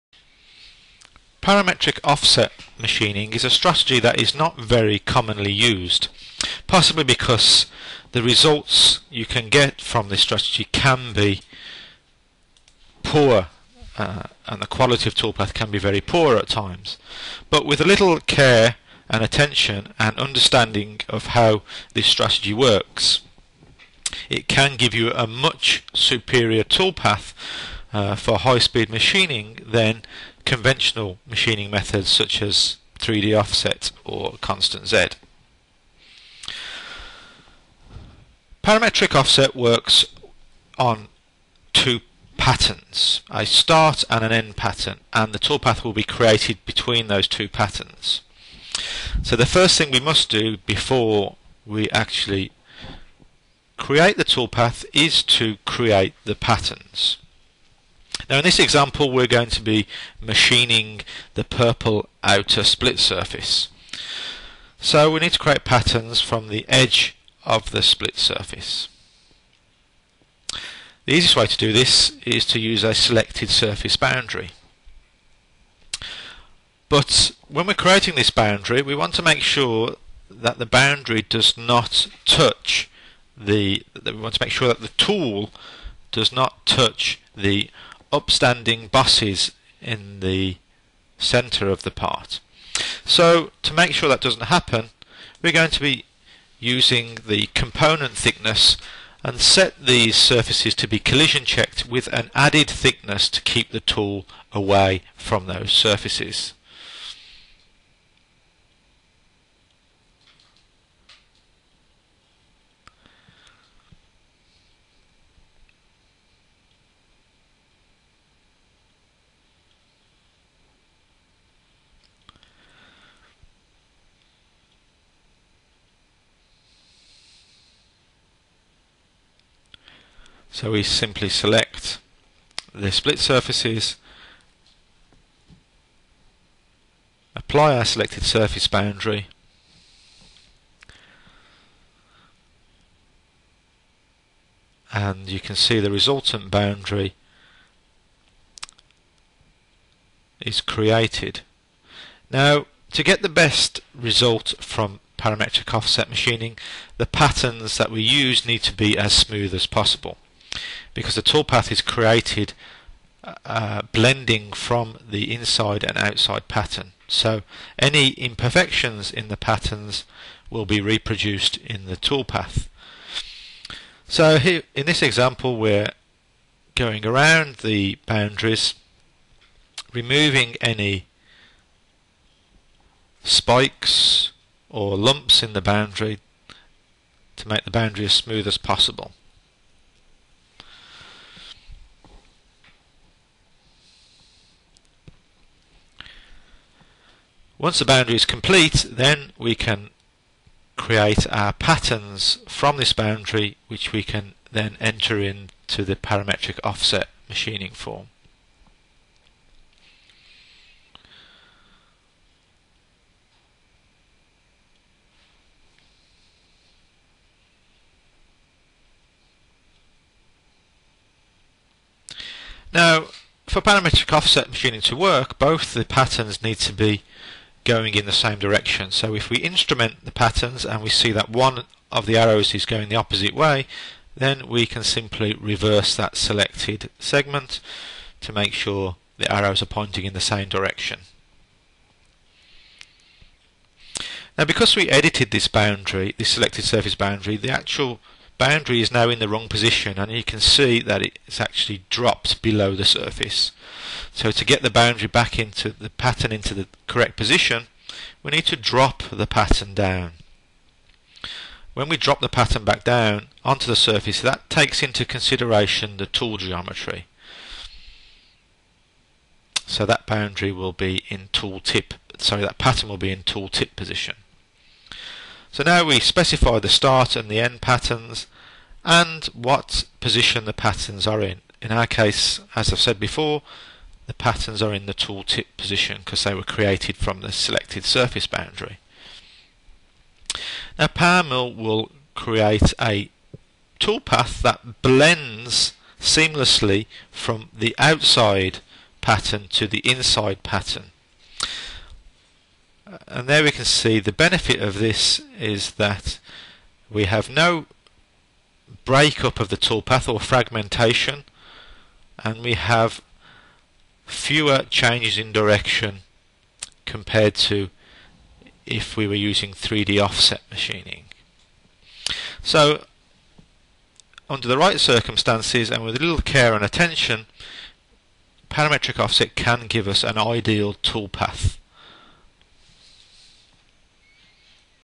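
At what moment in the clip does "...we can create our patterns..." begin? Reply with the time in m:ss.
3:19.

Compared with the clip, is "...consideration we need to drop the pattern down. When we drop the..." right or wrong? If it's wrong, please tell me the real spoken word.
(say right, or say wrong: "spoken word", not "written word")
wrong: "position", not "consideration".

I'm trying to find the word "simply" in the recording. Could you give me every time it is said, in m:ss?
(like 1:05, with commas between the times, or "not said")
2:10, 3:54.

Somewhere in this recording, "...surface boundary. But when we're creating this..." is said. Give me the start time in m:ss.
1:13.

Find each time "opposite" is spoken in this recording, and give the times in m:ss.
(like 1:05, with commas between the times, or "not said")
3:52.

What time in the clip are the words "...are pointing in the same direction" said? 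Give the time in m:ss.
3:59.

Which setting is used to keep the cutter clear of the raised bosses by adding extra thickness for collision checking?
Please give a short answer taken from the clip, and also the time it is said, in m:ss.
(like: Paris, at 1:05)
Component thickness, at 1:37.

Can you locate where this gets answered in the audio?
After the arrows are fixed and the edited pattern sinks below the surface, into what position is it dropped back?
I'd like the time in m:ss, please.
4:33.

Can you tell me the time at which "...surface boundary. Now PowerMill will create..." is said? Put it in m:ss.
4:47.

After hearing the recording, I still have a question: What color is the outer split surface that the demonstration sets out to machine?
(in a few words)
Purple.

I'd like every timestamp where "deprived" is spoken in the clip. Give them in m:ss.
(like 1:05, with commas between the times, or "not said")
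not said.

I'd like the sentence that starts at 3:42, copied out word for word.
Now, for parametric offset machining to work, both the patterns need to be going in the same direction.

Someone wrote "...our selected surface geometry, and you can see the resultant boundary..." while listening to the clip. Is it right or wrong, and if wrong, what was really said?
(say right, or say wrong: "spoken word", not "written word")
wrong: "boundary", not "geometry".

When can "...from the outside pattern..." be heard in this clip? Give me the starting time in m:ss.
4:57.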